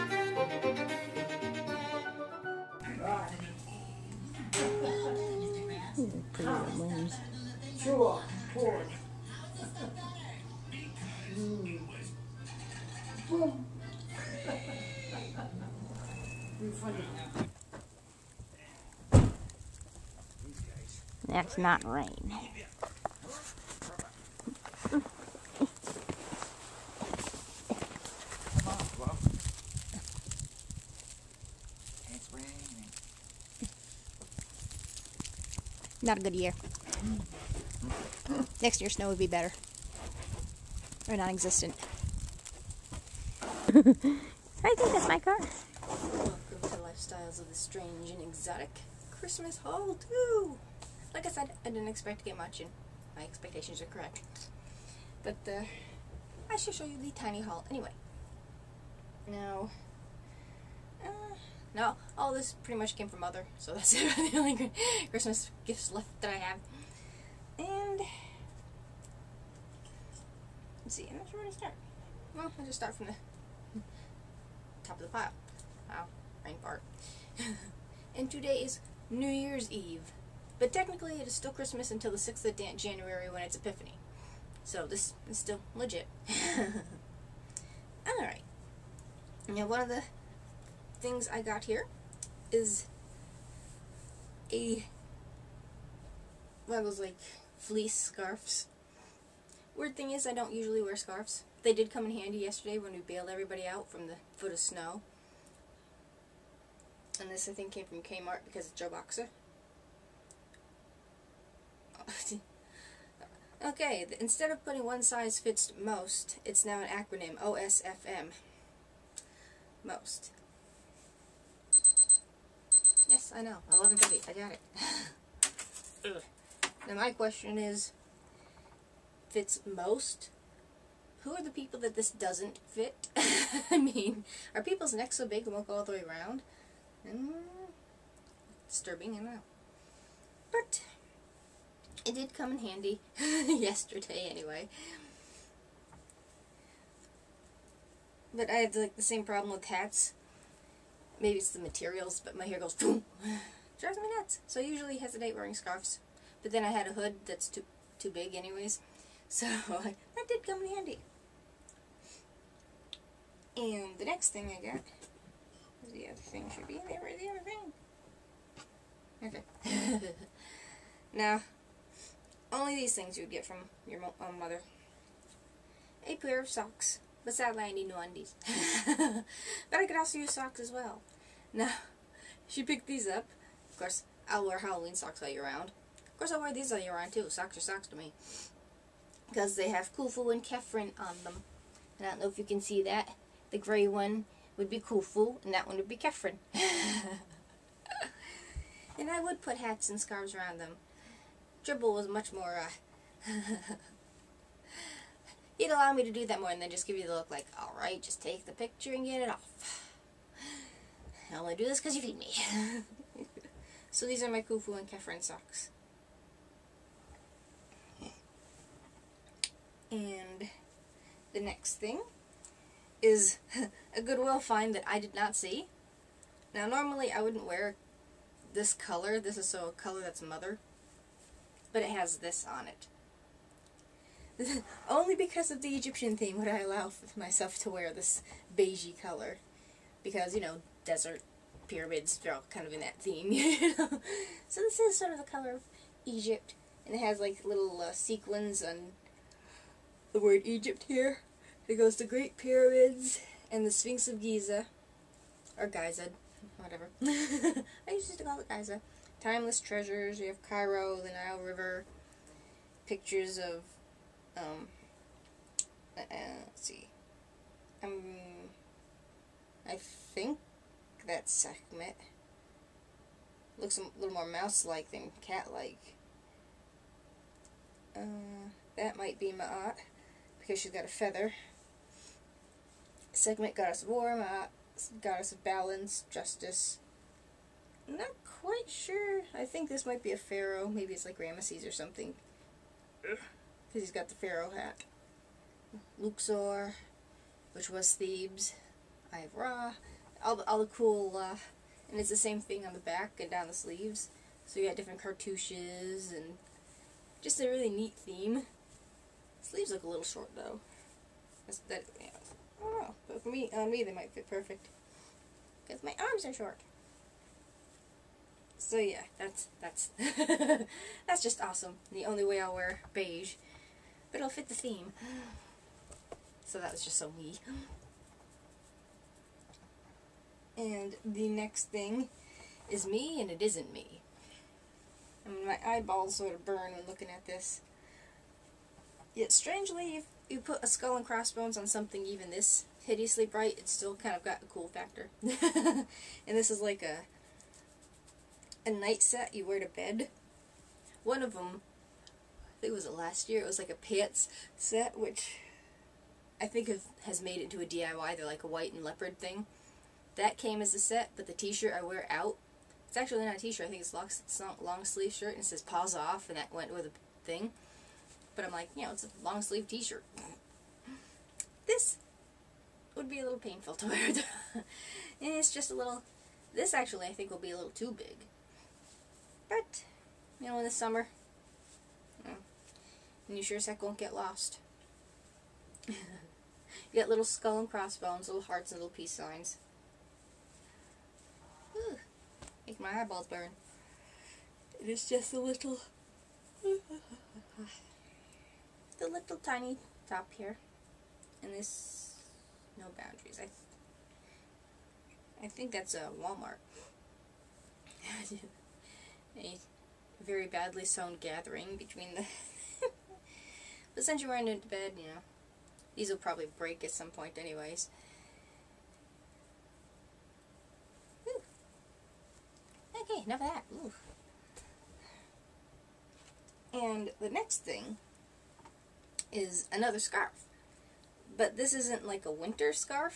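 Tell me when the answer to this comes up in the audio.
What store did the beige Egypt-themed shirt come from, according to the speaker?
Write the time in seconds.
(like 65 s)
224 s.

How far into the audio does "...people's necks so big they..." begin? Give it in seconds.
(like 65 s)
134 s.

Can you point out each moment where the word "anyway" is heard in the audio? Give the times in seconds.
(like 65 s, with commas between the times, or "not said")
57 s, 144 s, 158 s, 417 s.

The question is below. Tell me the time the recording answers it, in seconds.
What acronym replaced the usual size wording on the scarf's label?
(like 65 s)
117 s.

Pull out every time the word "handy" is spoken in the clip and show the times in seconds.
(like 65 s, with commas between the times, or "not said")
102 s, 142 s, 160 s.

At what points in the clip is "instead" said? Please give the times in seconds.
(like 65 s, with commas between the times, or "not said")
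114 s.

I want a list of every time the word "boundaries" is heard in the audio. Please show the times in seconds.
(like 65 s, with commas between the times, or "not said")
402 s.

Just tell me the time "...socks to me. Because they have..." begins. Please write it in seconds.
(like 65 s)
187 s.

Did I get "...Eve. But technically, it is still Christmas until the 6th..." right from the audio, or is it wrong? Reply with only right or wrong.
right.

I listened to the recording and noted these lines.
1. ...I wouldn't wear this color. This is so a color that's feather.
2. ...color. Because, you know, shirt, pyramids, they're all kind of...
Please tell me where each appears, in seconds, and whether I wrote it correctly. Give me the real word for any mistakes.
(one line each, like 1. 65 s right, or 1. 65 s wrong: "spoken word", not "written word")
1. 227 s wrong: "mother", not "feather"
2. 239 s wrong: "desert", not "shirt".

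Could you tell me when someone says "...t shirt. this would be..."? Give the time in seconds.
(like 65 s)
369 s.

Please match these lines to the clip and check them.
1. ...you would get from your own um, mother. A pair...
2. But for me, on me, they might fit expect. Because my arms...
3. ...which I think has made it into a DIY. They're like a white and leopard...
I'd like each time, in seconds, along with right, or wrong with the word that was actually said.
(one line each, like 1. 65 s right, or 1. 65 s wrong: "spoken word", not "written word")
1. 173 s right
2. 313 s wrong: "perfect", not "expect"
3. 354 s right.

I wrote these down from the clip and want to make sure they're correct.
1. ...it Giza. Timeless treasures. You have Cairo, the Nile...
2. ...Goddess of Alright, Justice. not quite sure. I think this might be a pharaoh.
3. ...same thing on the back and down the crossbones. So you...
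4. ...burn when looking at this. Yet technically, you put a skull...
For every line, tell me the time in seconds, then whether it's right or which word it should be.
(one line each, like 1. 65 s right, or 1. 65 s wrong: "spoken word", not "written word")
1. 258 s right
2. 285 s wrong: "Balance", not "Alright"
3. 302 s wrong: "sleeves", not "crossbones"
4. 336 s wrong: "strangely", not "technically".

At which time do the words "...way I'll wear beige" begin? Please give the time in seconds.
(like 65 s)
322 s.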